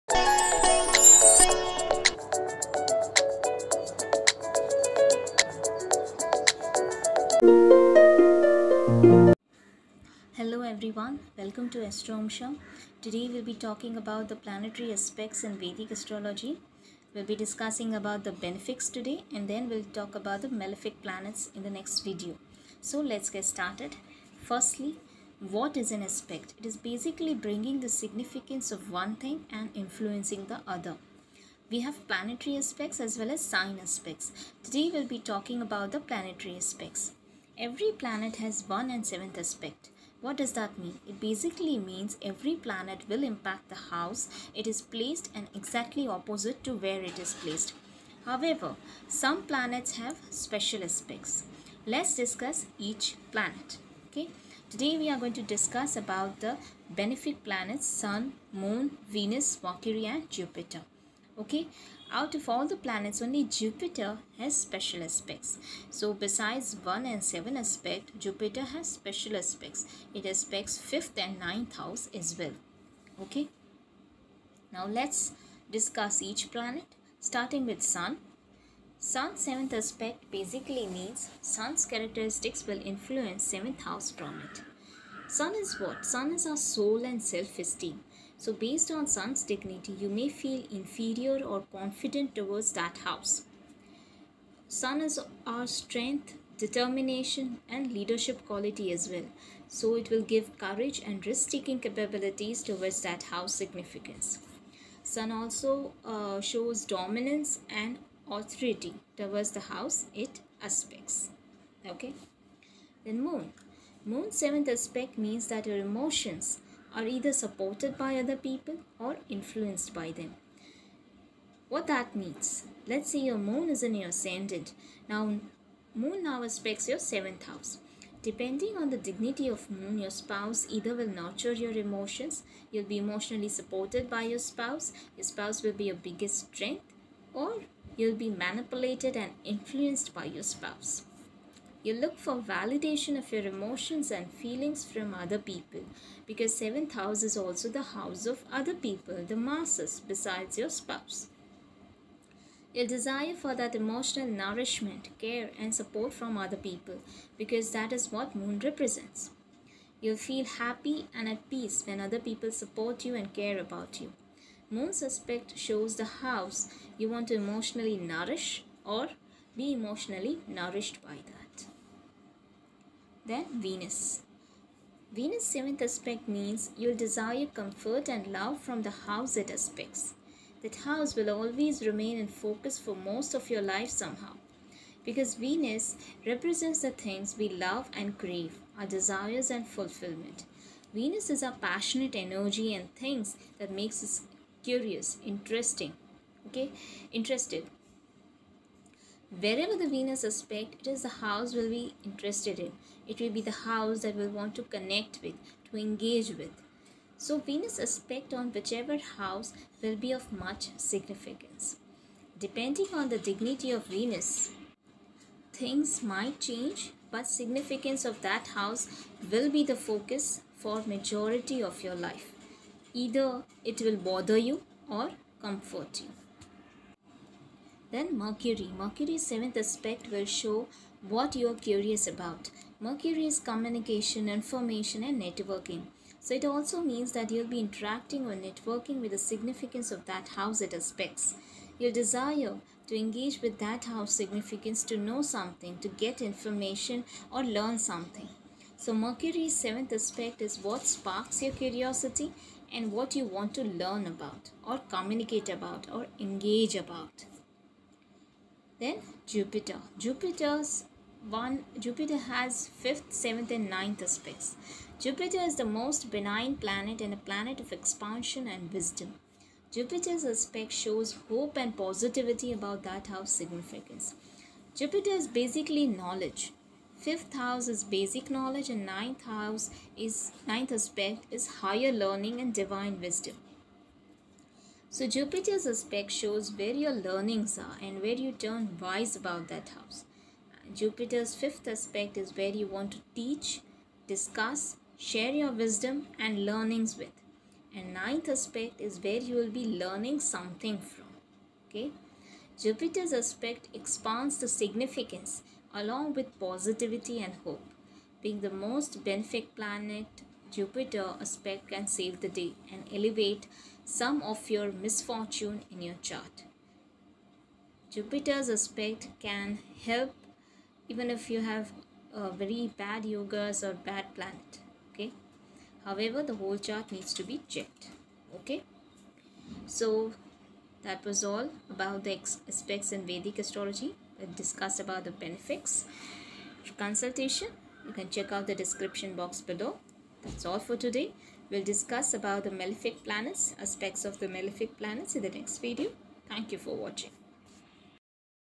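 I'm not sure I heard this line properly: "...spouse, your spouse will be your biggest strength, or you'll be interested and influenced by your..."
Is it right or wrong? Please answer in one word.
wrong.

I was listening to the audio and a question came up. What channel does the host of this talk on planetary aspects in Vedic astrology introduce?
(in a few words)
Astroamsa.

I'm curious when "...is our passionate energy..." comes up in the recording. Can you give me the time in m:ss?
3:11.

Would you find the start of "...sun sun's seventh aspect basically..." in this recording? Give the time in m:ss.
1:17.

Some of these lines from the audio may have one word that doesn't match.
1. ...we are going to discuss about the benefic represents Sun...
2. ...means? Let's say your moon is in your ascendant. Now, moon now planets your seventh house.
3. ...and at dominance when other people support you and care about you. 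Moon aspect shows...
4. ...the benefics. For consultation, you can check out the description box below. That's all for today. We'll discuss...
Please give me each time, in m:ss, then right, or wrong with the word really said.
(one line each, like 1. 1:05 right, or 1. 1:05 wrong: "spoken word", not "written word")
1. 0:54 wrong: "planets", not "represents"
2. 2:02 wrong: "aspects", not "planets"
3. 2:41 wrong: "peace", not "dominance"
4. 5:35 right.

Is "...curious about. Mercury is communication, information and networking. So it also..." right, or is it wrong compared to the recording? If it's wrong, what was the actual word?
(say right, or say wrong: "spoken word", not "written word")
right.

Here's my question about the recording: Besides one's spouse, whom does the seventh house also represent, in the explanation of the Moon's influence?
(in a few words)
the masses.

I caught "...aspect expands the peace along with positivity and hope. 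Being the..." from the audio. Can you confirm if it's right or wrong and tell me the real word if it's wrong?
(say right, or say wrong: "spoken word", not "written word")
wrong: "significance", not "peace".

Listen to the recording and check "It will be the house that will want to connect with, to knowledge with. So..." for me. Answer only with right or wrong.
wrong.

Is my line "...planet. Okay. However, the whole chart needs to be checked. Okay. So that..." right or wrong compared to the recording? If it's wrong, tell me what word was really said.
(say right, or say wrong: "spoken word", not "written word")
right.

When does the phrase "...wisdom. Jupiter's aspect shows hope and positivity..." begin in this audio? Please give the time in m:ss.
4:28.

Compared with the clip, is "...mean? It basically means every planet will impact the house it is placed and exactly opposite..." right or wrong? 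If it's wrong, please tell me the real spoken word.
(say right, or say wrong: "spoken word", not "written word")
right.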